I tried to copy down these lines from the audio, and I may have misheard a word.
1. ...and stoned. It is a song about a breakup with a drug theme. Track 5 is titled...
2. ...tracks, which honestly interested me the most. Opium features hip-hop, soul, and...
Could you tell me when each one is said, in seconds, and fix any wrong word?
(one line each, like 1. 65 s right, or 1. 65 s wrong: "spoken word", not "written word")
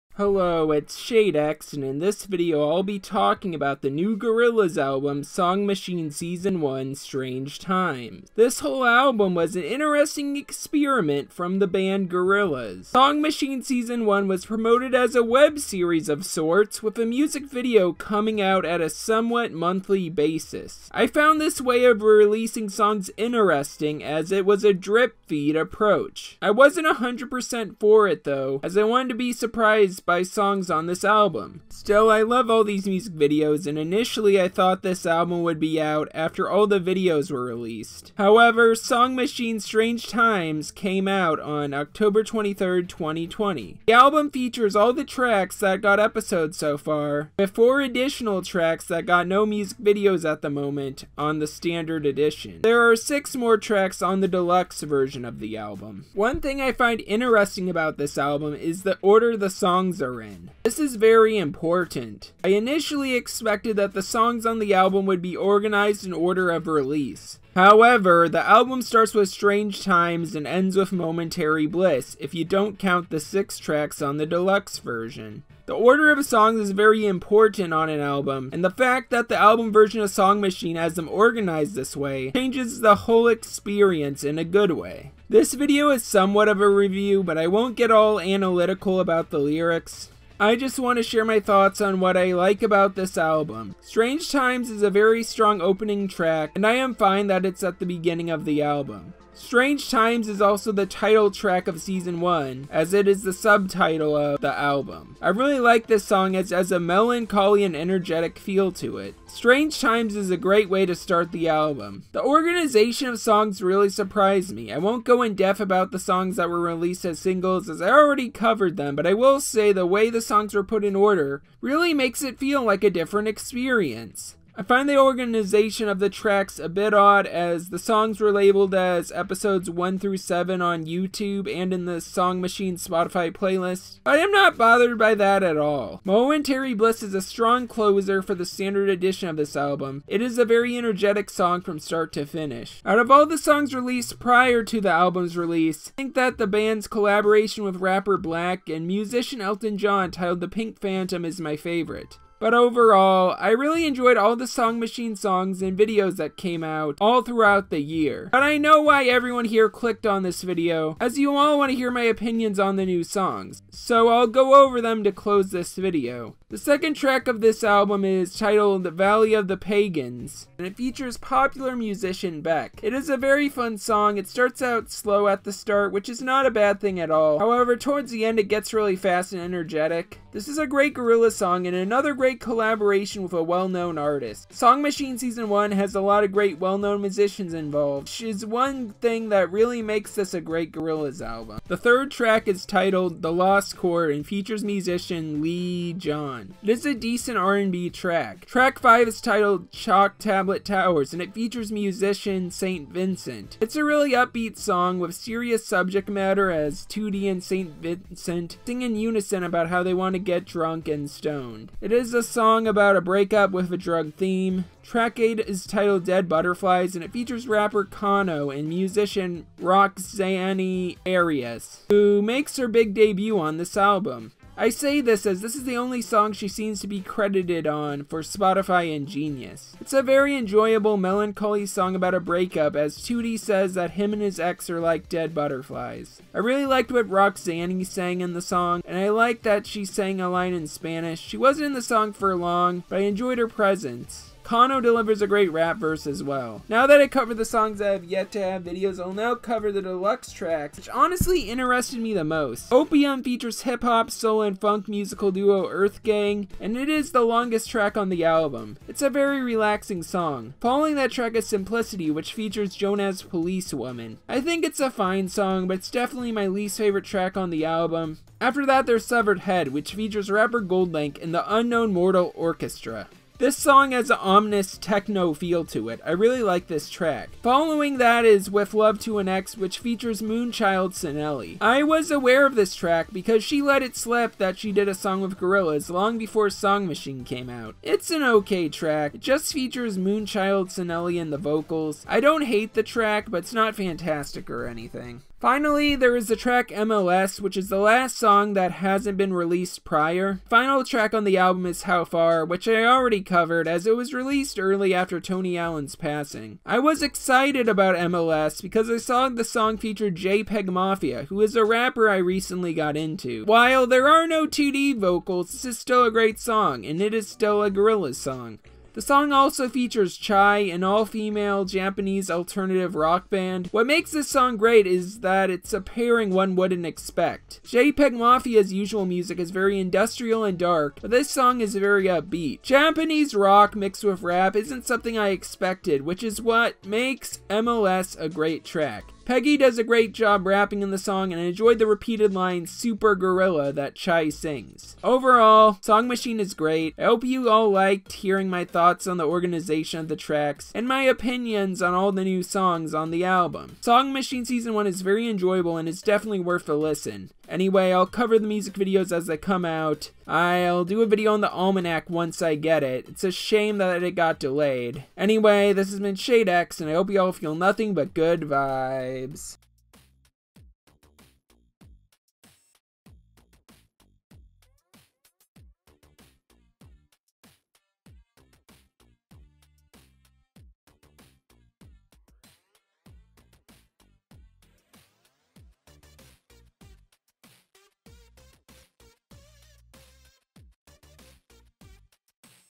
1. 210 s wrong: "8", not "5"
2. 250 s right.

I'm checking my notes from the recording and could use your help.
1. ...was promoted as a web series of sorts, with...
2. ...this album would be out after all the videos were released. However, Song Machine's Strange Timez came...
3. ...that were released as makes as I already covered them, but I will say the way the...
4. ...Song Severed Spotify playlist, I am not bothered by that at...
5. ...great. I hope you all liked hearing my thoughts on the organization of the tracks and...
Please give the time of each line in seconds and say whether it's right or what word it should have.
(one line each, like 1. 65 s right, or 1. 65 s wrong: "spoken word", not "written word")
1. 14 s right
2. 34 s right
3. 116 s wrong: "singles", not "makes"
4. 132 s wrong: "Machine", not "Severed"
5. 346 s right.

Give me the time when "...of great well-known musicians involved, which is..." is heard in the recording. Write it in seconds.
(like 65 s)
186 s.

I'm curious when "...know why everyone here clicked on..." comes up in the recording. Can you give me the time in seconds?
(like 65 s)
158 s.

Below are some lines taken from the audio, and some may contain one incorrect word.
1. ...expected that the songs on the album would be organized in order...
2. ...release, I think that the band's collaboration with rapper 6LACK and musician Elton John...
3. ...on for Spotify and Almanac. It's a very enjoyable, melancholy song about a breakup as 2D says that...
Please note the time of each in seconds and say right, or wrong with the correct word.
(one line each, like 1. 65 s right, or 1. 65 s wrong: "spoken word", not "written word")
1. 63 s right
2. 145 s right
3. 227 s wrong: "Genius", not "Almanac".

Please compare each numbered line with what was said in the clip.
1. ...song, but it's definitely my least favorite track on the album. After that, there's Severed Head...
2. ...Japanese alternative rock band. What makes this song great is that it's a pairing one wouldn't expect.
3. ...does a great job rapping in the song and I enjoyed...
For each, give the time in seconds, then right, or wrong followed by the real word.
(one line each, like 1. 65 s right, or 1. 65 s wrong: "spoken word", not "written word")
1. 265 s right
2. 321 s right
3. 339 s right.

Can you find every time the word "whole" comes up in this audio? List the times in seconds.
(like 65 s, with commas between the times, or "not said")
8 s, 82 s.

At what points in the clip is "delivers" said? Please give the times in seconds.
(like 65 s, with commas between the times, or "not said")
244 s.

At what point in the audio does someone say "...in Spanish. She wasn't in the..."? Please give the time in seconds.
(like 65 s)
240 s.